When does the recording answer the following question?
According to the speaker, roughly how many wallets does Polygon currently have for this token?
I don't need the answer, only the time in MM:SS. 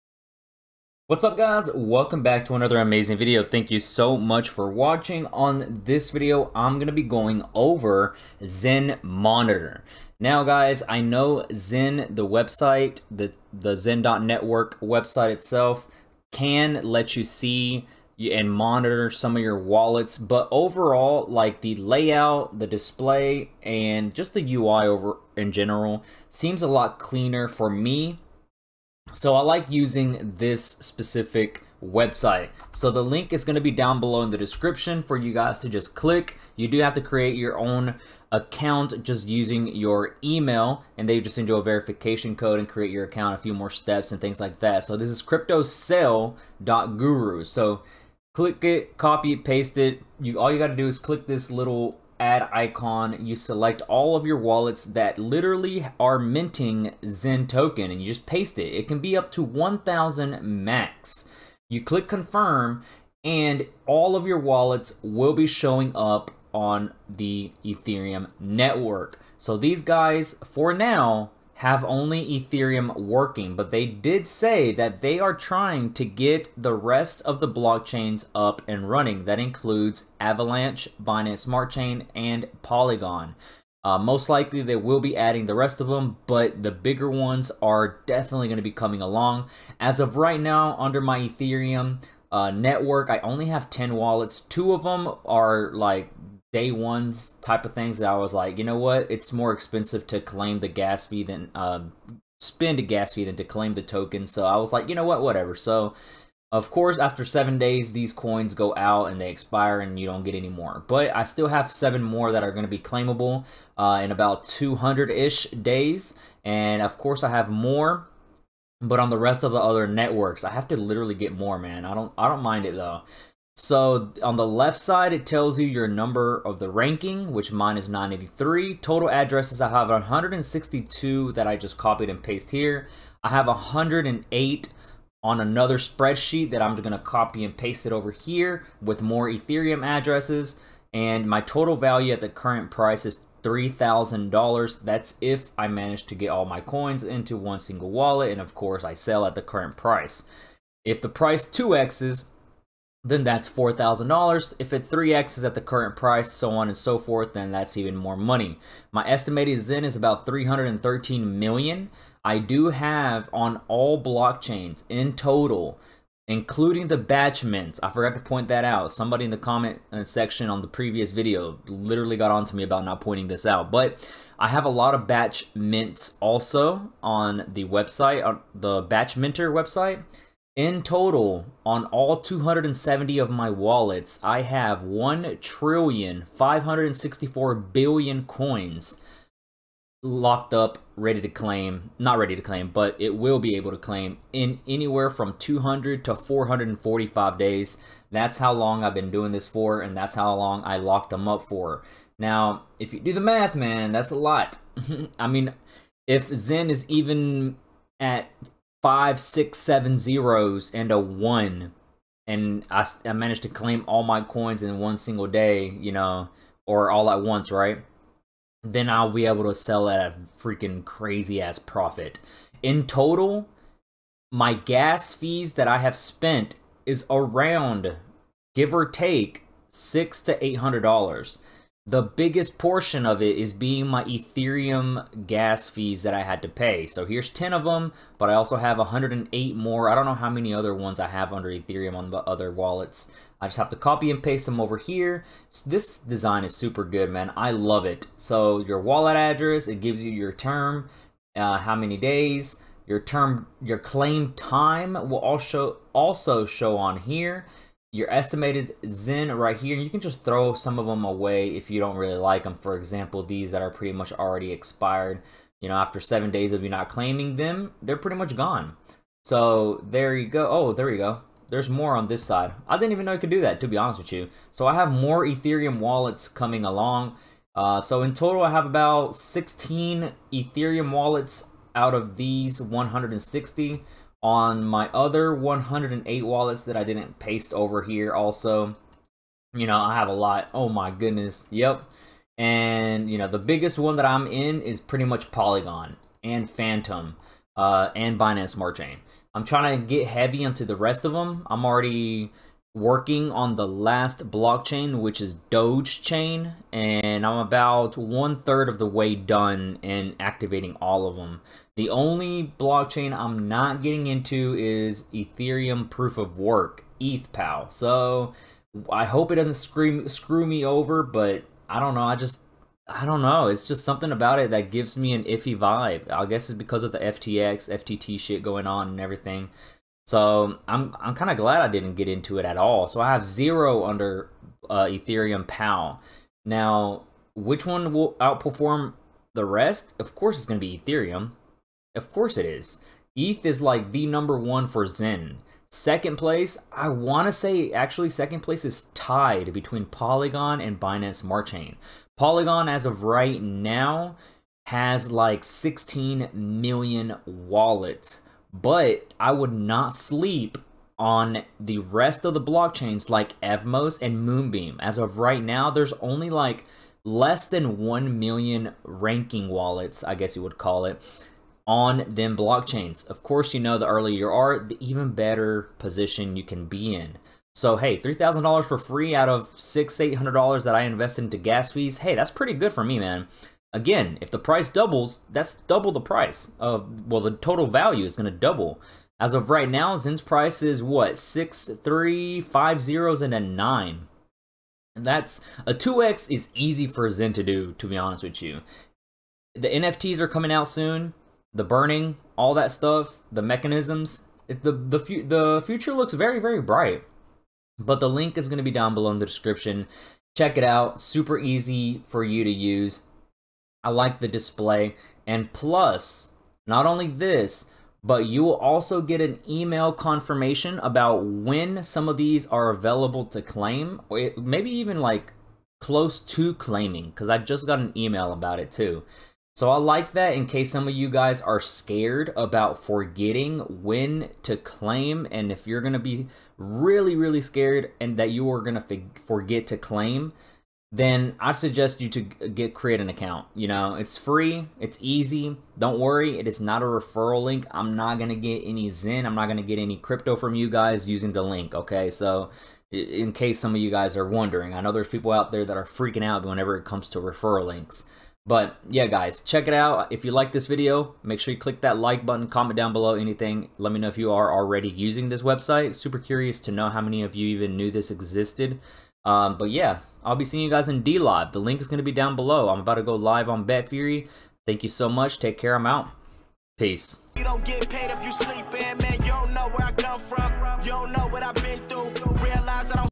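05:55.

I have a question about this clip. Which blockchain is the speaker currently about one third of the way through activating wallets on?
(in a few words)
Doge Chain.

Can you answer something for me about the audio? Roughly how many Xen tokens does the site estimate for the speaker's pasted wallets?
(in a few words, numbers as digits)
313 million.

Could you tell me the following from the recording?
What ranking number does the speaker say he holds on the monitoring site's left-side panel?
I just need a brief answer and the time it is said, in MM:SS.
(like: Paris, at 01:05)
983, at 02:07.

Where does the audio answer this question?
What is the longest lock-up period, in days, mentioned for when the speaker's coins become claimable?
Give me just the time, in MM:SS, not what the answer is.
03:16.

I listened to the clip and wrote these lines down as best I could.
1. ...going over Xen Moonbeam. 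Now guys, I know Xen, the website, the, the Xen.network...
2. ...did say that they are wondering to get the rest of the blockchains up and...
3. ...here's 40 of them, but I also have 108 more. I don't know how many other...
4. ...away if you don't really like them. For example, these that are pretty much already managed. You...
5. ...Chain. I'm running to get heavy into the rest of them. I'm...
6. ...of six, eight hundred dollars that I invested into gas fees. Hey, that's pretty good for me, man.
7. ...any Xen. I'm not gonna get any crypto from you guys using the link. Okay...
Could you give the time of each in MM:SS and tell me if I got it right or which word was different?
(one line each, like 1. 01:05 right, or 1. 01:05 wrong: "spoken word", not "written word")
1. 00:07 wrong: "Monitor", not "Moonbeam"
2. 01:13 wrong: "trying", not "wondering"
3. 03:57 wrong: "10", not "40"
4. 04:21 wrong: "expired", not "managed"
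5. 04:58 wrong: "trying", not "running"
6. 06:19 right
7. 07:28 right.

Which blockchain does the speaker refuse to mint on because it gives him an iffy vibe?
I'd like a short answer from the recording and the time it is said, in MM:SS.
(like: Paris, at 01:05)
Ethereum Proof of Work, at 05:15.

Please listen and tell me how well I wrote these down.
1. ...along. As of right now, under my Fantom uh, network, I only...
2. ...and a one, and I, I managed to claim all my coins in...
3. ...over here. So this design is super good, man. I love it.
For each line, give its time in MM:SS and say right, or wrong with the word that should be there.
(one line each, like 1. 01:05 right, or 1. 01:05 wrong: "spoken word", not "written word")
1. 01:29 wrong: "Ethereum", not "Fantom"
2. 03:30 right
3. 04:04 right.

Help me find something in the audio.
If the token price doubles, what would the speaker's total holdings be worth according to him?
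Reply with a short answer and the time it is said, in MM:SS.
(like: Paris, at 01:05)
$4,000, at 02:33.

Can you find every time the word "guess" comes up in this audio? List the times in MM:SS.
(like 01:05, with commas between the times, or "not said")
05:26, 06:10.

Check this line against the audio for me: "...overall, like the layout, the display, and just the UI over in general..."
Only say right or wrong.
right.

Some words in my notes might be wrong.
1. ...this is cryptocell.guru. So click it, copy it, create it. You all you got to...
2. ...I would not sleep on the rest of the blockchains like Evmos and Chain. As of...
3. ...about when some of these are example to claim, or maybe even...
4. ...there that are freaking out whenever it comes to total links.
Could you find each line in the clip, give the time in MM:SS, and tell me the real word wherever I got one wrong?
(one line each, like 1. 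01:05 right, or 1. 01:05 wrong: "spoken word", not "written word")
1. 00:44 wrong: "paste", not "create"
2. 05:59 wrong: "Moonbeam", not "Chain"
3. 07:00 wrong: "available", not "example"
4. 07:35 wrong: "referral", not "total".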